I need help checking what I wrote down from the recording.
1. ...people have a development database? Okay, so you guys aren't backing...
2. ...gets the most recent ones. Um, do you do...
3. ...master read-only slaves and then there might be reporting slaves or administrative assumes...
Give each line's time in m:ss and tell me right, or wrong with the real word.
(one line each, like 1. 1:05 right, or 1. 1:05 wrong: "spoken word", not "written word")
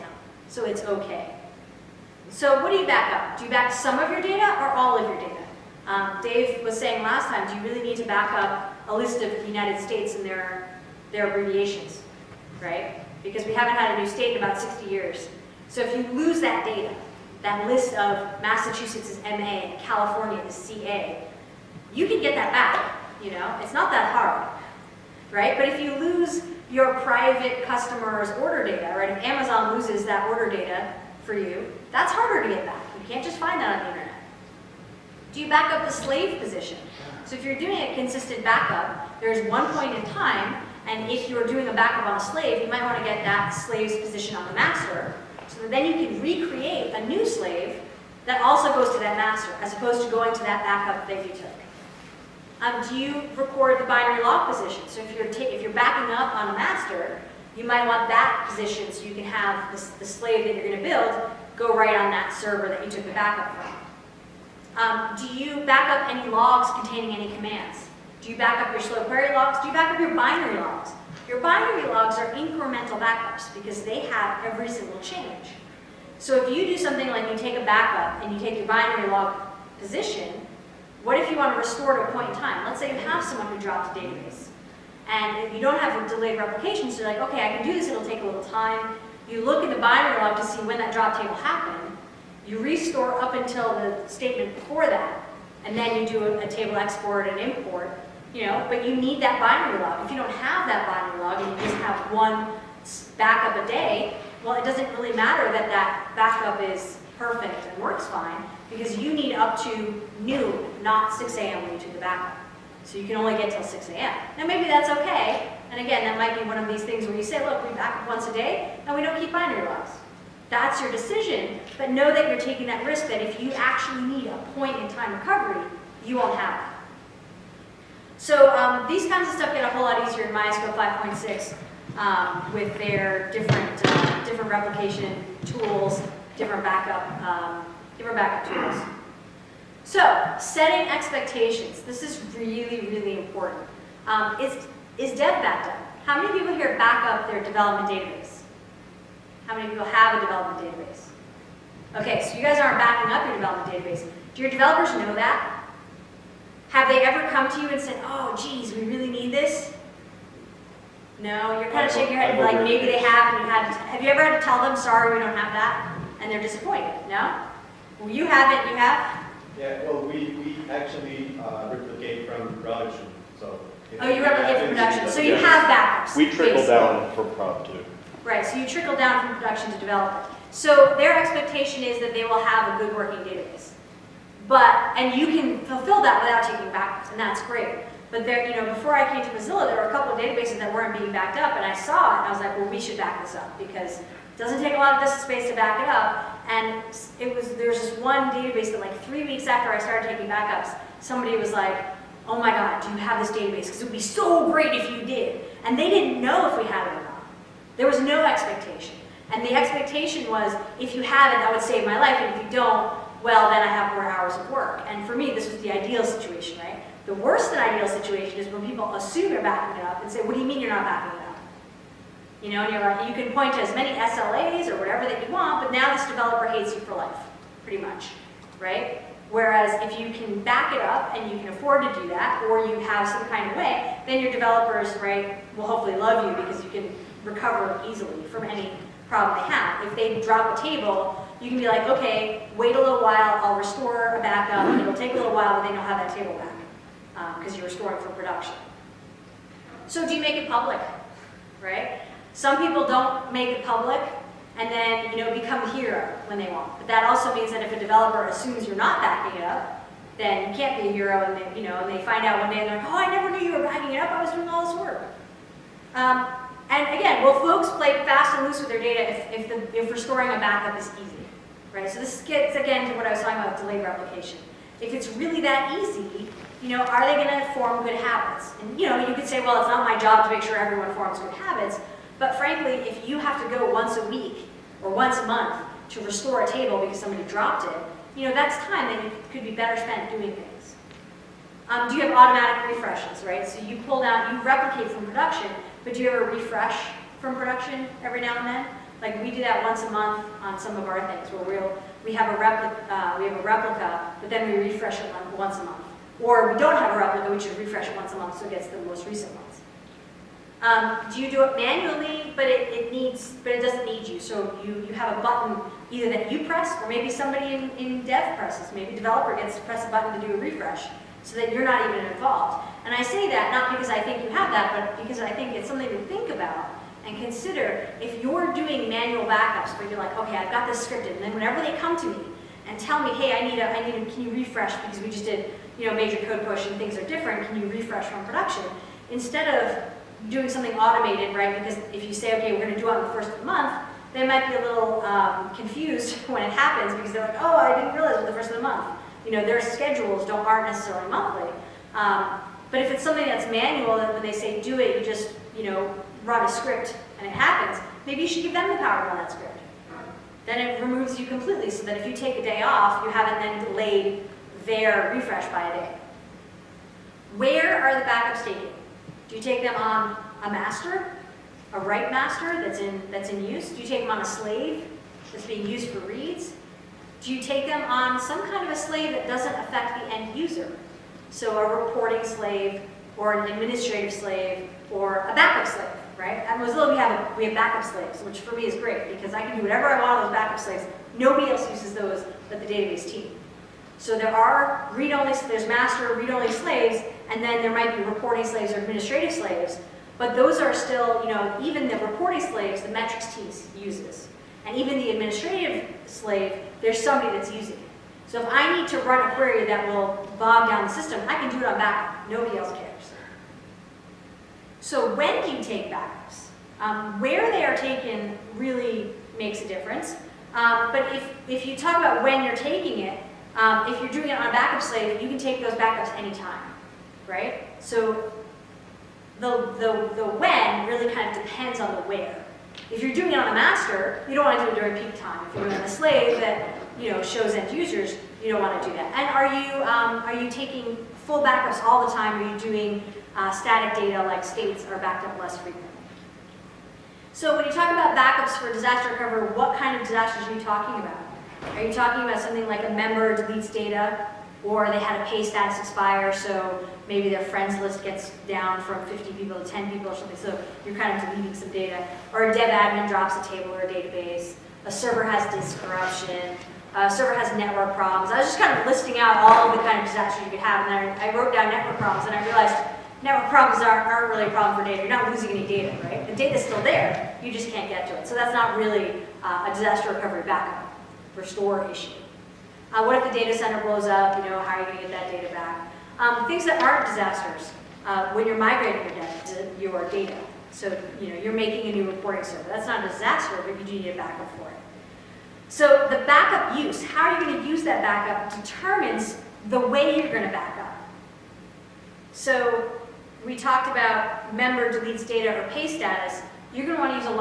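1. 2:29 right
2. 5:08 right
3. 6:35 wrong: "slaves", not "assumes".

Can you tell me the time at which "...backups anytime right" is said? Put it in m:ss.
7:05.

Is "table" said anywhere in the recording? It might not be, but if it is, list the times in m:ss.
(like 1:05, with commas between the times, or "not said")
1:31, 1:36, 4:00, 4:06, 4:46, 7:43.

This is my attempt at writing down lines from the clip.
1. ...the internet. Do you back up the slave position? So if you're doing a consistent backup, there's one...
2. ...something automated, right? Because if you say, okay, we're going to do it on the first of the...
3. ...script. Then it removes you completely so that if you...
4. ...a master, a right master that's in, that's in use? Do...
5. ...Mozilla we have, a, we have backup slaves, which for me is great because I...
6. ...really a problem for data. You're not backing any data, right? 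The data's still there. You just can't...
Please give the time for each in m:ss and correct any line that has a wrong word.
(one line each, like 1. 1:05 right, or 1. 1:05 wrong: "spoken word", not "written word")
1. 0:33 right
2. 5:40 right
3. 5:59 right
4. 6:10 right
5. 6:26 right
6. 7:54 wrong: "losing", not "backing".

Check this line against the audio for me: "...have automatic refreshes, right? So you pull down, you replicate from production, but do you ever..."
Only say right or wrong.
right.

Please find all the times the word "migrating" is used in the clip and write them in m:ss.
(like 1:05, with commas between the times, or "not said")
8:08.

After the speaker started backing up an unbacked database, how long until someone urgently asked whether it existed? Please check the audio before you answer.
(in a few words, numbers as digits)
three weeks.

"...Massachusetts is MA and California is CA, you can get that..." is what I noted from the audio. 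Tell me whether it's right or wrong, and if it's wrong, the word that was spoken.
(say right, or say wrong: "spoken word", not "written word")
right.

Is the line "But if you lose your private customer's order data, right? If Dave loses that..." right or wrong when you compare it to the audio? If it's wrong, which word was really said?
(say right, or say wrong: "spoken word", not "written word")
wrong: "Amazon", not "Dave".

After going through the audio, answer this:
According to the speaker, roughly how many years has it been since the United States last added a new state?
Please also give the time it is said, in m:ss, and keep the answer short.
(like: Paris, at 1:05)
60 years, at 0:14.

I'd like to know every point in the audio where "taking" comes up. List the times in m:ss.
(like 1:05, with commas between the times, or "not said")
2:02, 3:06, 3:20, 7:02, 7:20.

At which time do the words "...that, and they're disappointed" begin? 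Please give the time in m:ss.
2:45.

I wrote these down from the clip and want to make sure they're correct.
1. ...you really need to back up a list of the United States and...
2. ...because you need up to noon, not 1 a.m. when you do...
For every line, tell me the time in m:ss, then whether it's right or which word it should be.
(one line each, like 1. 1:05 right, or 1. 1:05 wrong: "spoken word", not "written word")
1. 0:07 right
2. 1:48 wrong: "6", not "1".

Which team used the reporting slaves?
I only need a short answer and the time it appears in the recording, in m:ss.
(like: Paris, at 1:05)
metrics team, at 6:42.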